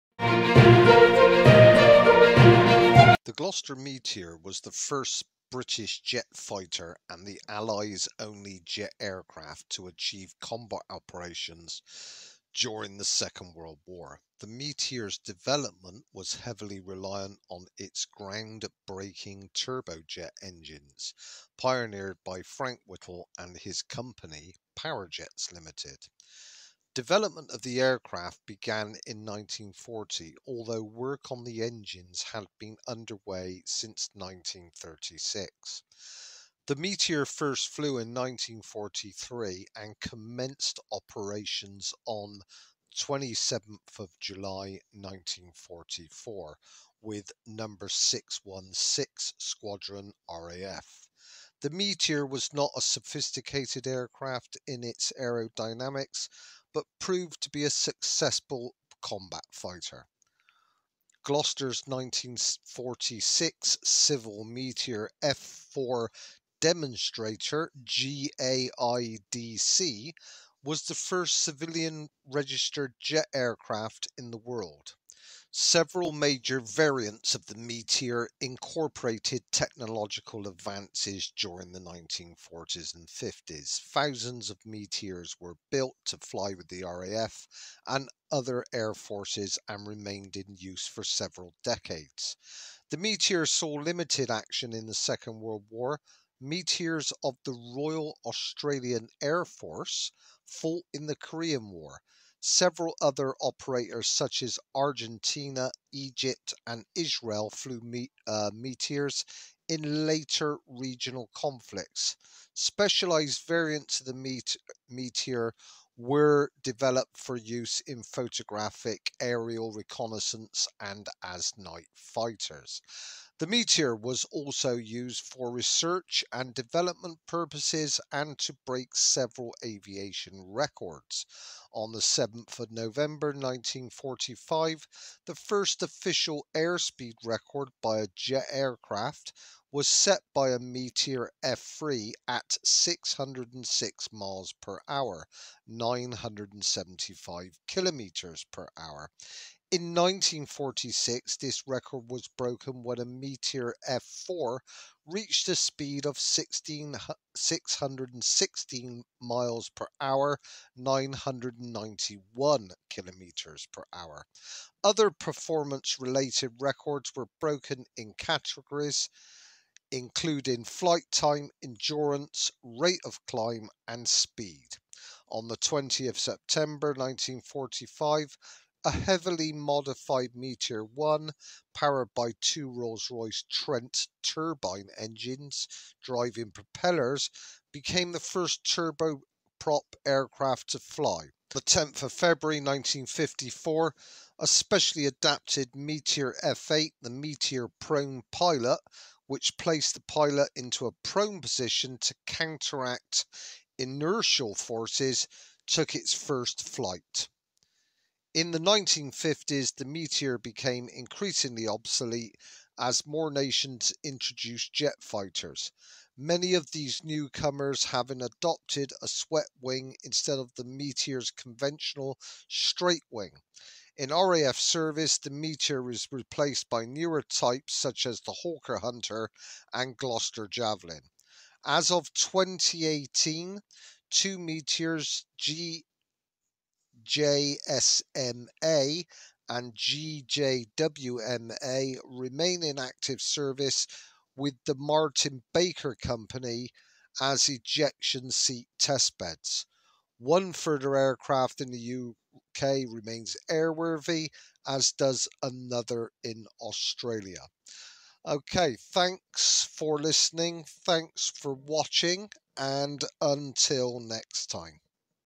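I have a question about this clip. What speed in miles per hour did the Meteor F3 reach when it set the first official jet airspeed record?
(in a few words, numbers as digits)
606 miles per hour.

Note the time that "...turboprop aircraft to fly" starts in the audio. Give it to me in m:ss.
3:08.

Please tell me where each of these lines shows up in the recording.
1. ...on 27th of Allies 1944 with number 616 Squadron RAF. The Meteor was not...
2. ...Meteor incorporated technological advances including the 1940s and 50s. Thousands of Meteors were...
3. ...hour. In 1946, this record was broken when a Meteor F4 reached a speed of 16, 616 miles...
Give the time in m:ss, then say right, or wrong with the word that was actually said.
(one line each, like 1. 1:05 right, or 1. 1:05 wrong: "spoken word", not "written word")
1. 0:42 wrong: "July", not "Allies"
2. 1:17 wrong: "during", not "including"
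3. 2:28 right.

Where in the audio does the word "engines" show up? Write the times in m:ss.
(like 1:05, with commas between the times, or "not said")
0:20, 0:31, 3:04.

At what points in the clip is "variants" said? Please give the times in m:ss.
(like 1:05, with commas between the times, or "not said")
1:16, 1:53.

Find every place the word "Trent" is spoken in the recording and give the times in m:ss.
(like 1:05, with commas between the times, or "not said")
3:03.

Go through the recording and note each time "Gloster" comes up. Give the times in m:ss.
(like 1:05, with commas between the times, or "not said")
0:03, 1:01, 3:49.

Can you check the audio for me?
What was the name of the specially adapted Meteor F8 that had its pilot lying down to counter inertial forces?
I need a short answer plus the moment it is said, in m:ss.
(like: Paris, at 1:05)
Meteor prone pilot, at 3:17.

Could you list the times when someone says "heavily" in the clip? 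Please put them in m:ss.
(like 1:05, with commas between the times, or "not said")
0:16, 2:58.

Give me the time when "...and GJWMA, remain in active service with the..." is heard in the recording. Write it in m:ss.
3:59.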